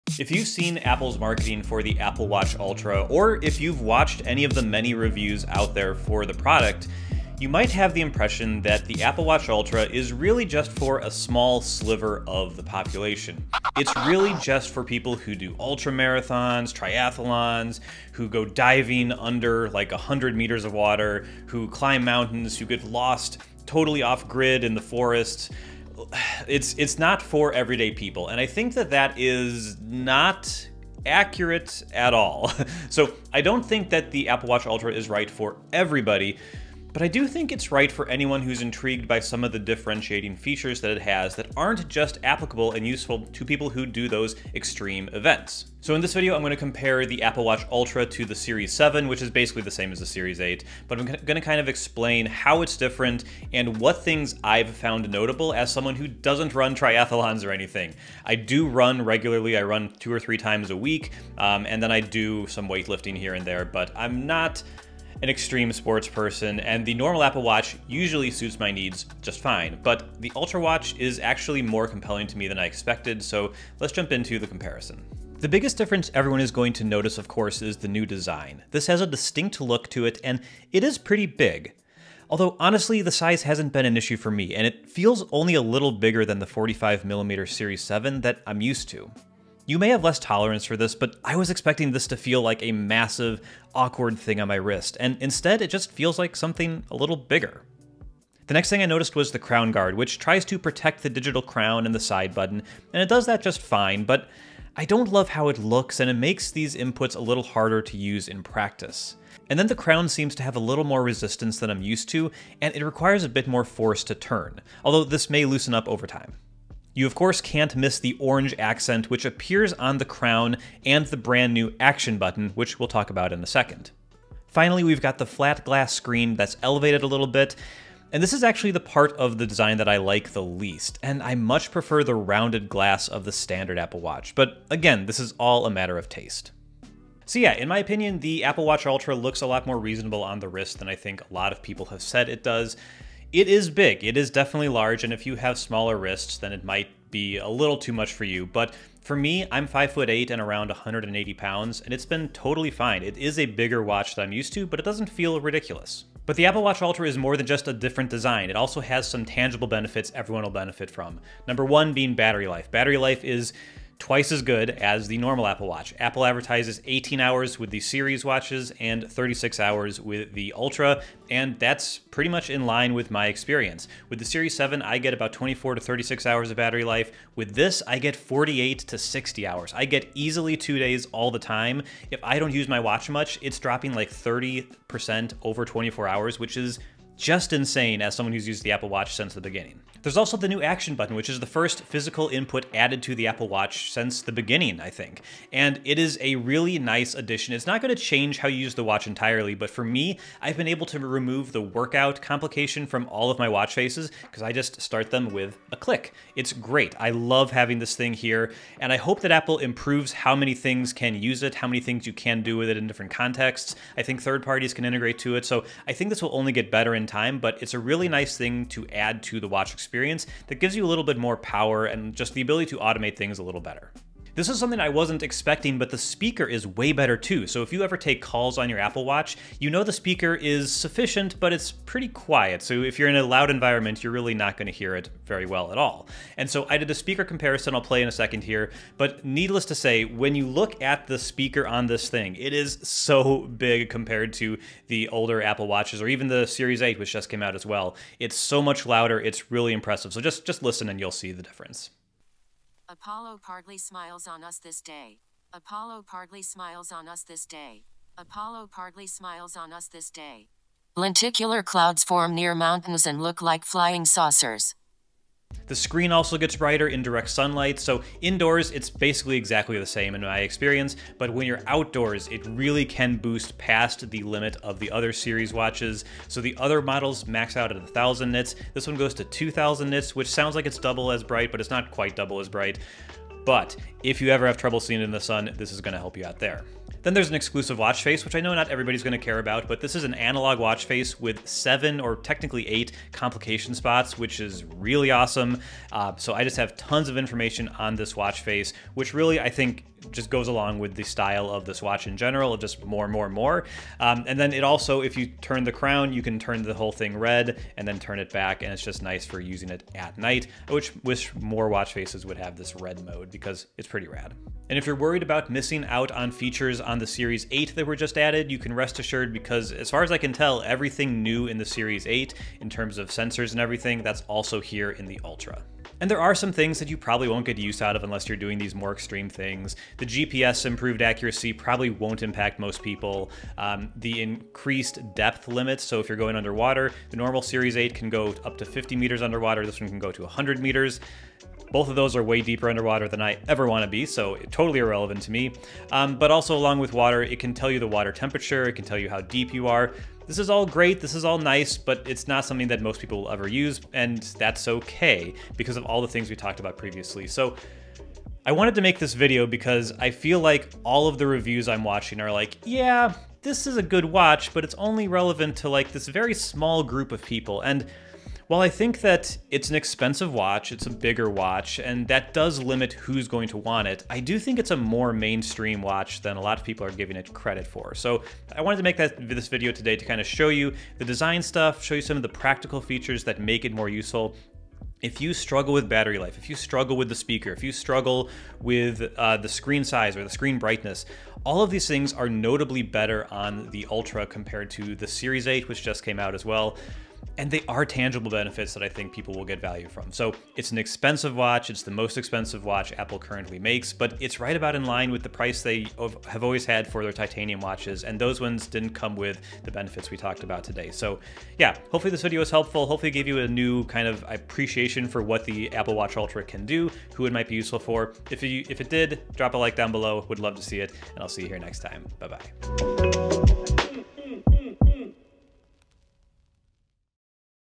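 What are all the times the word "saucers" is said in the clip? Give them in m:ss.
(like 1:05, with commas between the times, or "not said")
4:24.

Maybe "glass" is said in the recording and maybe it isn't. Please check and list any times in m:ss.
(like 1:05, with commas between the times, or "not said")
2:05, 2:12.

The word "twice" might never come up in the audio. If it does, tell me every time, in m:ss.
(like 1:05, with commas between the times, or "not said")
2:44.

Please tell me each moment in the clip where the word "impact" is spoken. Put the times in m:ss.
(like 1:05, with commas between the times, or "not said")
5:32.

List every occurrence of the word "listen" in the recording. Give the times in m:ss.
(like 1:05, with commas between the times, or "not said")
4:10.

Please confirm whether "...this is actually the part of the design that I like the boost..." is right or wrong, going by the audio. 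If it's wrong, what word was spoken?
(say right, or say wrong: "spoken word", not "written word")
wrong: "least", not "boost".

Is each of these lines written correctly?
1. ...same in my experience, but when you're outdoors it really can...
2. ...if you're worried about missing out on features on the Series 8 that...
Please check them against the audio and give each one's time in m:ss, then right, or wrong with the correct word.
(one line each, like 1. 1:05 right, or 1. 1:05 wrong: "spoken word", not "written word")
1. 4:29 right
2. 5:14 right.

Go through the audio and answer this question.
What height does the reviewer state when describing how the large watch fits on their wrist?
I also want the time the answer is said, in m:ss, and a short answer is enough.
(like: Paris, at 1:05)
5 foot 8, at 2:29.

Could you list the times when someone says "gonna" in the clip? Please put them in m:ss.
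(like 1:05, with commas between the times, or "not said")
3:54, 4:49.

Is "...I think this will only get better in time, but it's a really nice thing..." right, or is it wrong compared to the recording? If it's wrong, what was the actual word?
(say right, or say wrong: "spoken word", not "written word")
right.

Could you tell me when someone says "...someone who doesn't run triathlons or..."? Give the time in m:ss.
0:55.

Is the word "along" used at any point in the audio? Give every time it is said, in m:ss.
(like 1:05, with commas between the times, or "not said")
5:00, 5:46.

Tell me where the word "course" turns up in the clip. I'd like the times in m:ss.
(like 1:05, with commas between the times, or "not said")
1:17, 1:57.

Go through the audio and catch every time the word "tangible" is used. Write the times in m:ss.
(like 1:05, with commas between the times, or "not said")
2:39, 6:37.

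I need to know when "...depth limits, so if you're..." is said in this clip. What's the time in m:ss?
5:35.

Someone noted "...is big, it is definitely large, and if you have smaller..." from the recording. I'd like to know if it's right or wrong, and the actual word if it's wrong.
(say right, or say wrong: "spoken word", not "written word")
right.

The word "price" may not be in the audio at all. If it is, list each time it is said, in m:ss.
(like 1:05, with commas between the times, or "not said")
6:45.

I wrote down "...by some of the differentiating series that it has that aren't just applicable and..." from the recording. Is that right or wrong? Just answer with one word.
wrong.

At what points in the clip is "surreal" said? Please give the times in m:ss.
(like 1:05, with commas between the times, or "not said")
not said.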